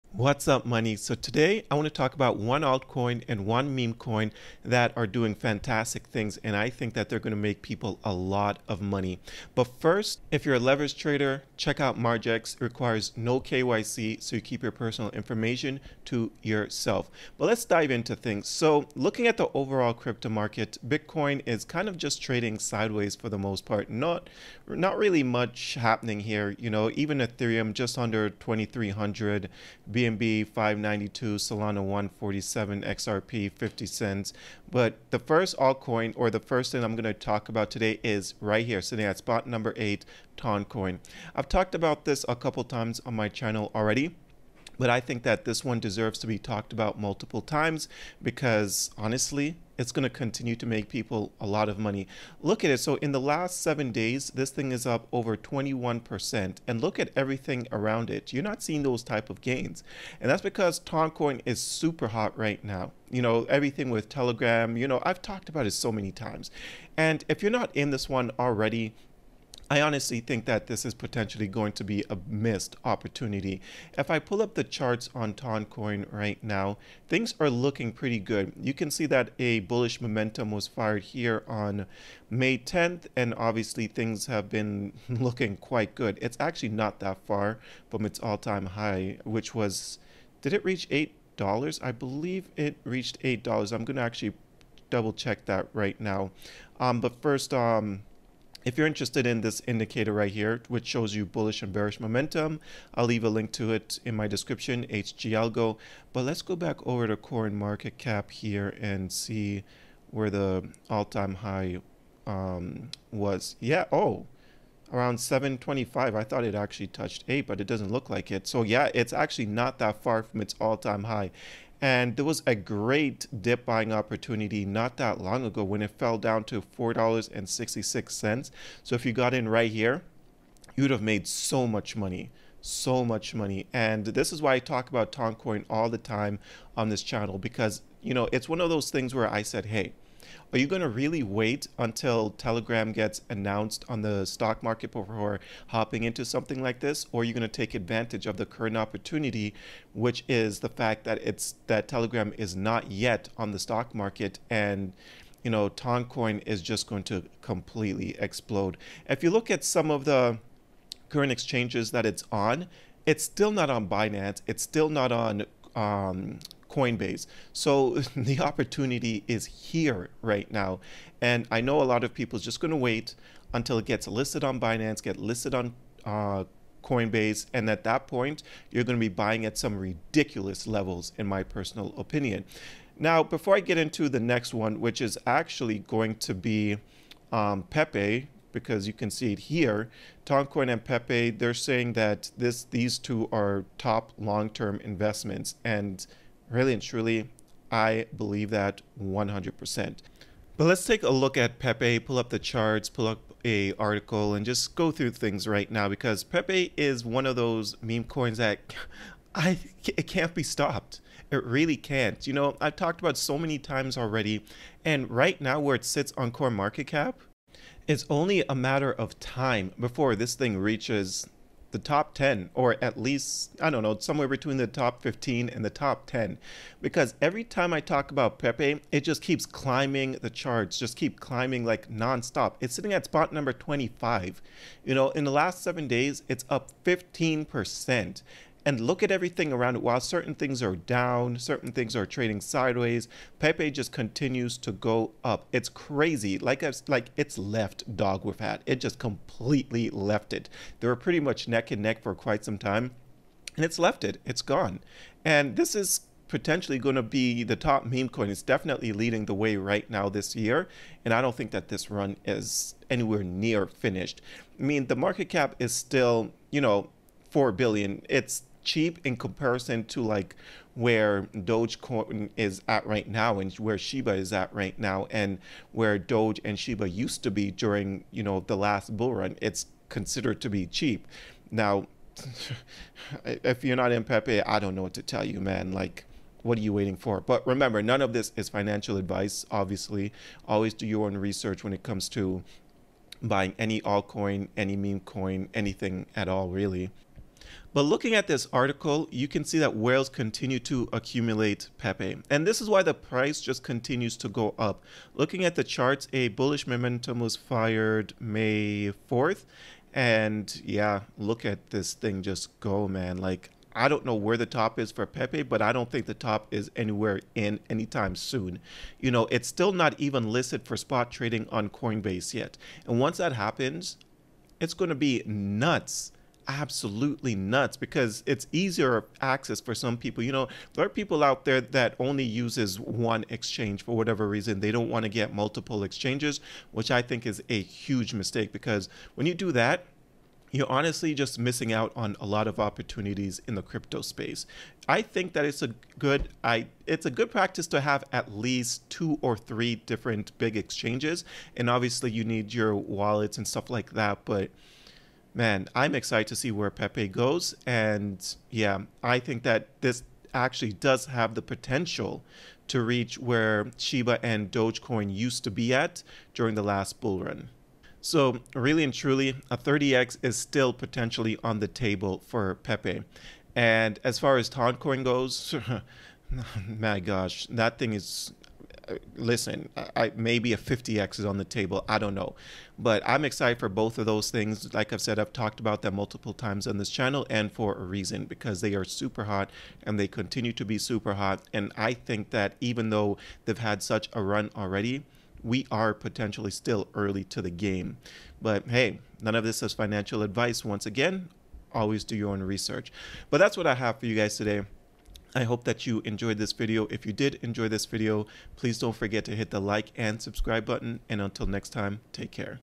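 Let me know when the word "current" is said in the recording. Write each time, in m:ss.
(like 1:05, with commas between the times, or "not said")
2:28, 2:41.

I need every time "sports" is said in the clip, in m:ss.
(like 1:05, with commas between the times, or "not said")
not said.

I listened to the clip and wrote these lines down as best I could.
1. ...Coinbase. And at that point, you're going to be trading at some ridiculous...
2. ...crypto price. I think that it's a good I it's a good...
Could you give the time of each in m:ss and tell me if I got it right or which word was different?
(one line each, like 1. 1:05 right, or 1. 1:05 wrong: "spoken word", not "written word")
1. 2:56 wrong: "buying", not "trading"
2. 5:43 wrong: "space", not "price".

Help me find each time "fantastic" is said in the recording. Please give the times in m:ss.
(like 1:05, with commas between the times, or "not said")
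0:05.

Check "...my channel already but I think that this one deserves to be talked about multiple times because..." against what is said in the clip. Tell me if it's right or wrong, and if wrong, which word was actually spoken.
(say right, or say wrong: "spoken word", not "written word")
right.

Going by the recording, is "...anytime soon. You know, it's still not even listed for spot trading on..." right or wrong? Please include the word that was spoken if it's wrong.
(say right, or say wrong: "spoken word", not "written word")
right.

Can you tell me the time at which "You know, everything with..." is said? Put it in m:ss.
1:03.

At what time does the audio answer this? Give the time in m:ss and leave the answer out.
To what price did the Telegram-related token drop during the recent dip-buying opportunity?
2:06.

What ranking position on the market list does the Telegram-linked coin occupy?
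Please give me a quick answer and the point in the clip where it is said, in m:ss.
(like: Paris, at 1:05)
8, at 0:39.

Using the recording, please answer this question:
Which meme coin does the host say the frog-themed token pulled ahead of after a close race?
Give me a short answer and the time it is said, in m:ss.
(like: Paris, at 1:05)
dogwifhat, at 4:07.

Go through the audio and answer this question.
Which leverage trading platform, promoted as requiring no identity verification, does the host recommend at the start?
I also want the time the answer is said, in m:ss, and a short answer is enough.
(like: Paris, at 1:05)
Margex, at 0:11.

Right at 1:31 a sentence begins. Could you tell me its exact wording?
I believe it reached eight dollars.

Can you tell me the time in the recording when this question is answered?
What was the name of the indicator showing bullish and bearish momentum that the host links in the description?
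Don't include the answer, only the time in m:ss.
1:44.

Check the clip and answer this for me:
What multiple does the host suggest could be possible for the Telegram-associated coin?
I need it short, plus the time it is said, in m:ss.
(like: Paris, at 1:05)
50x, at 6:20.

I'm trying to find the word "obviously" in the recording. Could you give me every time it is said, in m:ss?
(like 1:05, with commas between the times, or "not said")
1:23, 4:49, 5:51.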